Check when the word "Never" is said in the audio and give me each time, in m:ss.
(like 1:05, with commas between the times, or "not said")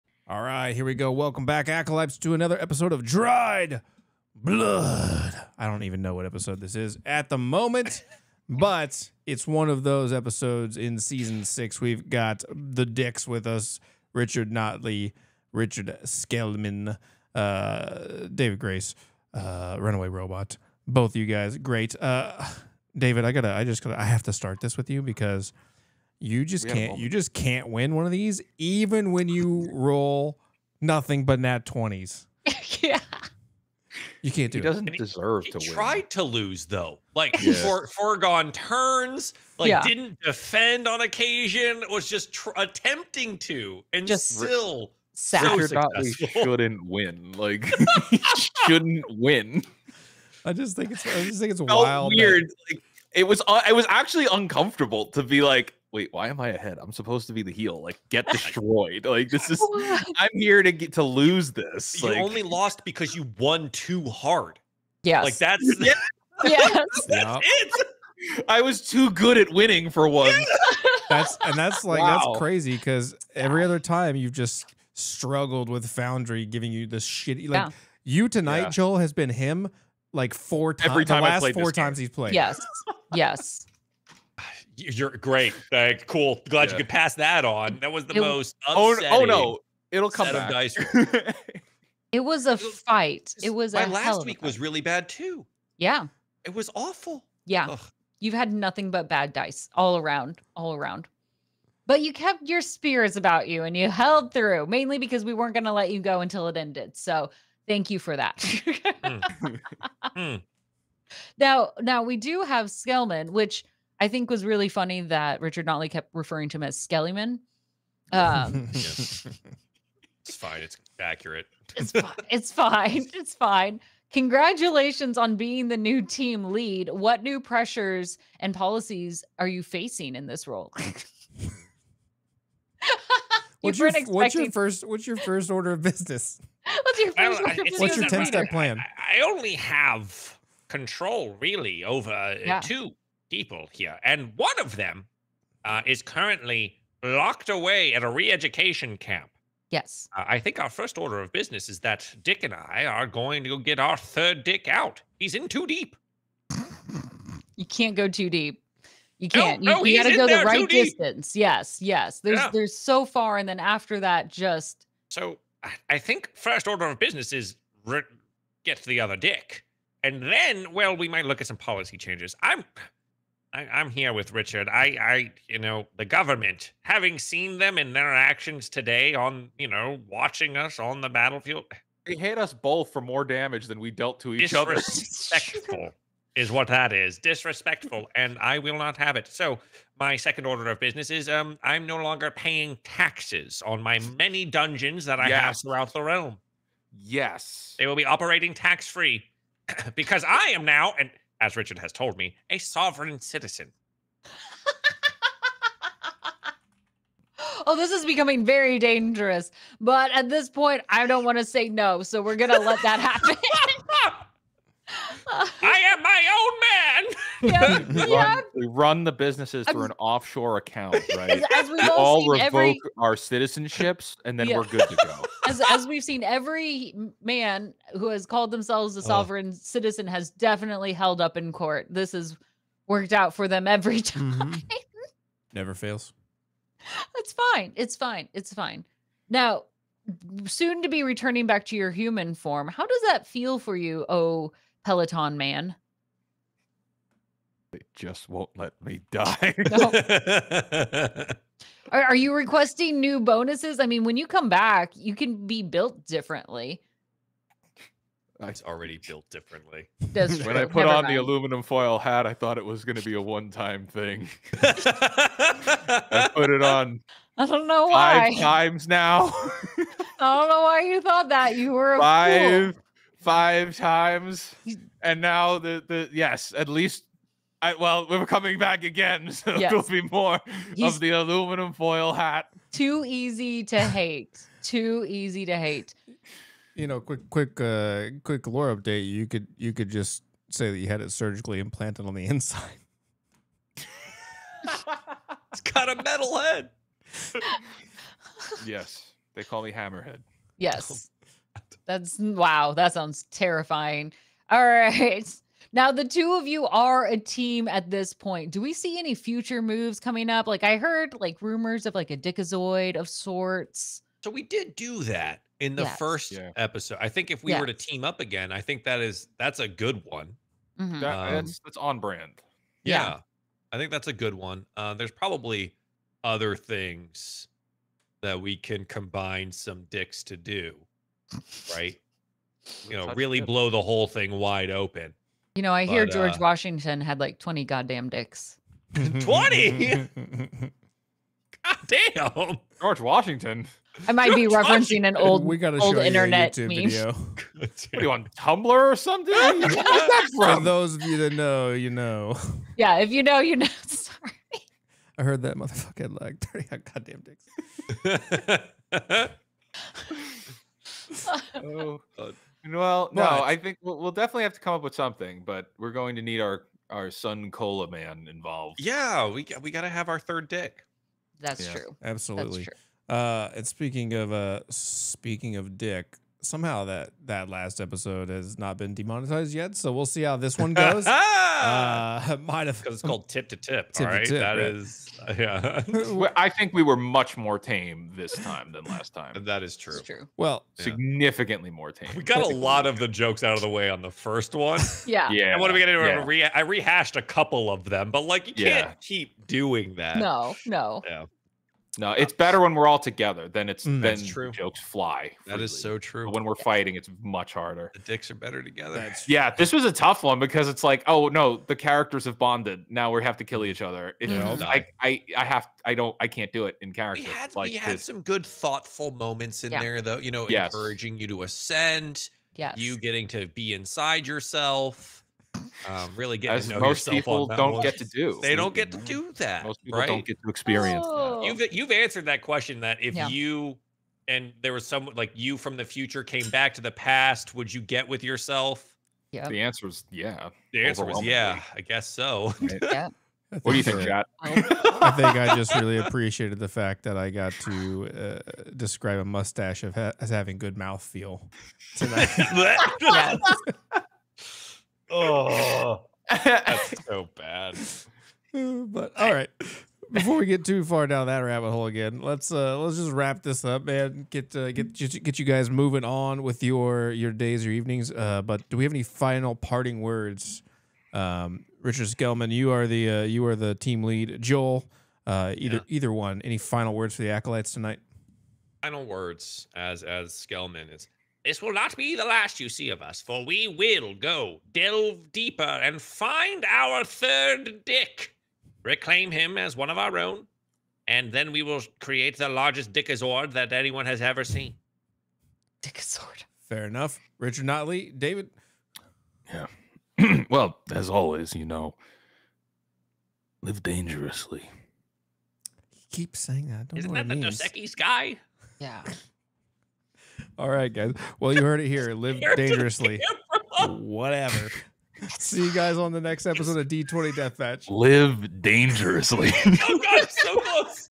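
3:55, 4:20.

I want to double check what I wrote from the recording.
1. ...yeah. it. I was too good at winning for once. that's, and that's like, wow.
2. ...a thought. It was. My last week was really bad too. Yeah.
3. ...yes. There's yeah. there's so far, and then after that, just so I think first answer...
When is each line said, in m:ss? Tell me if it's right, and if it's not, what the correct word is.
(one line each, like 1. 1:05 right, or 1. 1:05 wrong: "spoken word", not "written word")
1. 1:07 right
2. 1:32 wrong: "fight", not "thought"
3. 2:41 wrong: "order", not "answer".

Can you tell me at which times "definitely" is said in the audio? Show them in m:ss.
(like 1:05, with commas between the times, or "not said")
3:50, 6:04.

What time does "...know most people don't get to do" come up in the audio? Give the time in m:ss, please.
7:06.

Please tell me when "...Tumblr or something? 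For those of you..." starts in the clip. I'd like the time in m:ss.
5:48.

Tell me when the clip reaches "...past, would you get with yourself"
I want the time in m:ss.
7:16.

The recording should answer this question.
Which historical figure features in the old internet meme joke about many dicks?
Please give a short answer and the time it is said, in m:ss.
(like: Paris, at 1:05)
George Washington, at 5:42.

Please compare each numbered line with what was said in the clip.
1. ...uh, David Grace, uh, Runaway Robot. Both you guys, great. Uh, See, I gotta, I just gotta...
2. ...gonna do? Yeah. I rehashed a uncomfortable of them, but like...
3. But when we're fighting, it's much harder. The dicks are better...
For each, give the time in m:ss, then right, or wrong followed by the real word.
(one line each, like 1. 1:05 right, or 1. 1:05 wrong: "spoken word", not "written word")
1. 0:17 wrong: "David", not "See"
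2. 6:35 wrong: "couple", not "uncomfortable"
3. 6:46 right.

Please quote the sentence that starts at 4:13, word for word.
I mean, when you come back, you can be built differently.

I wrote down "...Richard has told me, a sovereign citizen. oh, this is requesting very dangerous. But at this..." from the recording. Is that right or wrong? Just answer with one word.
wrong.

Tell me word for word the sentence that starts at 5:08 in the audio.
Do we see any future moves coming up?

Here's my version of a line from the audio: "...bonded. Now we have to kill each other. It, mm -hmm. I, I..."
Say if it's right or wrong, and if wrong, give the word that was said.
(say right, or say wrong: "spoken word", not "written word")
right.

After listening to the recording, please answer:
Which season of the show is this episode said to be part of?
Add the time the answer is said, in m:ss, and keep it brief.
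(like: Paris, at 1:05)
6, at 0:10.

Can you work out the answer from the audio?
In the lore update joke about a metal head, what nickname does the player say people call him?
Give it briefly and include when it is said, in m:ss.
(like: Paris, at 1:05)
Hammerhead, at 4:59.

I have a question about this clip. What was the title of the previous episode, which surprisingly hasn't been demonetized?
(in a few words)
tip to tip.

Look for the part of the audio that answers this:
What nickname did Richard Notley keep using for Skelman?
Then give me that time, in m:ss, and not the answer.
1:56.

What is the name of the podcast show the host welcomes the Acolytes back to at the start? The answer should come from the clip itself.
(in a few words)
Dried Blood.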